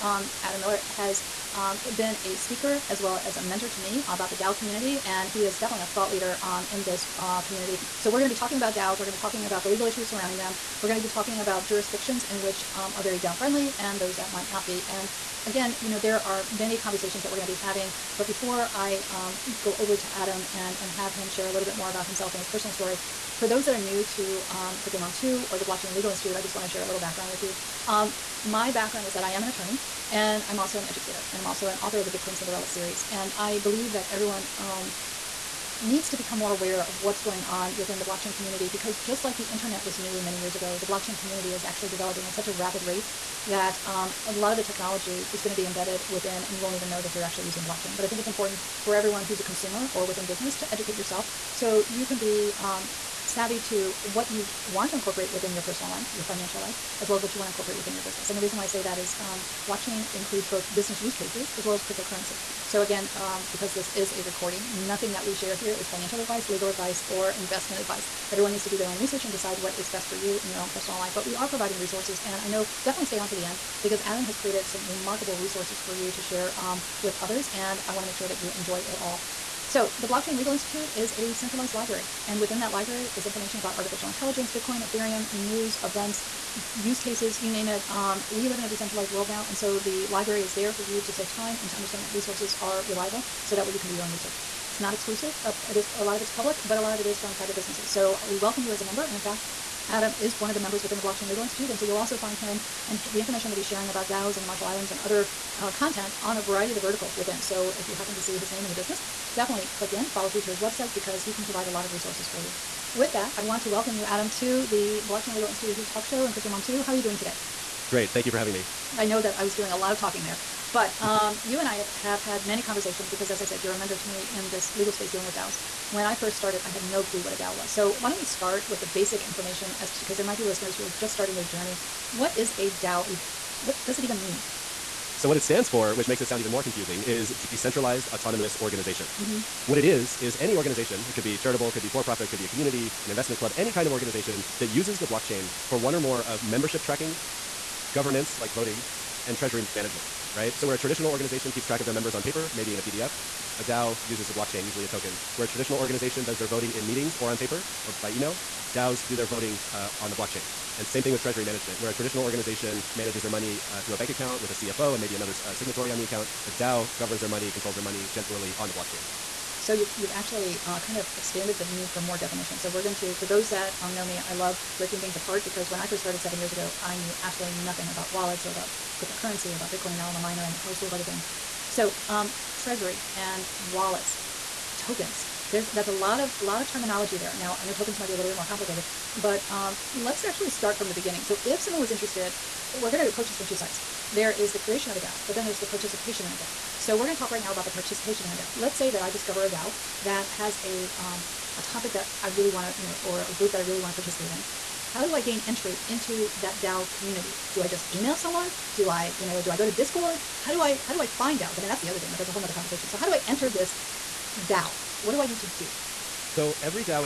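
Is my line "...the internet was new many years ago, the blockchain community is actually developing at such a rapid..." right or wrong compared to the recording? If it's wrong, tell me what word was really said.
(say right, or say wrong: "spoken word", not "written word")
right.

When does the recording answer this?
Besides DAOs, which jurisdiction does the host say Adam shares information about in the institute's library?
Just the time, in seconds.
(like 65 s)
104 s.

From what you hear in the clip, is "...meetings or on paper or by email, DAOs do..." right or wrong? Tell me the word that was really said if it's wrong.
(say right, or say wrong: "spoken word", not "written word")
right.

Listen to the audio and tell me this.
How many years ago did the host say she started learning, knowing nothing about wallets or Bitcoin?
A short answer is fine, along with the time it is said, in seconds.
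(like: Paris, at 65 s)
7, at 176 s.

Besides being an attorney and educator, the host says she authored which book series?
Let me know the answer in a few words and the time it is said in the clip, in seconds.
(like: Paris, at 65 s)
Bitcoin Cinderella series, at 32 s.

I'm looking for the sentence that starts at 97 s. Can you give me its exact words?
So we welcome you as a member.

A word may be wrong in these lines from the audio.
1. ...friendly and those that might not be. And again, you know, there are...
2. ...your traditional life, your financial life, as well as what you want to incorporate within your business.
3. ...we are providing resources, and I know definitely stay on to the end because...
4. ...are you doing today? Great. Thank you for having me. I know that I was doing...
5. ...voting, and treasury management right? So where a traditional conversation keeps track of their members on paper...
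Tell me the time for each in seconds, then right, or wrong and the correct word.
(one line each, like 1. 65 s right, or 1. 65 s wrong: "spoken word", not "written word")
1. 13 s right
2. 55 s wrong: "personal", not "traditional"
3. 71 s right
4. 116 s right
5. 148 s wrong: "organization", not "conversation".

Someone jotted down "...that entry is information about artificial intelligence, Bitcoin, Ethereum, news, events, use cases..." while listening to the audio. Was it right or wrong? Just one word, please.
wrong.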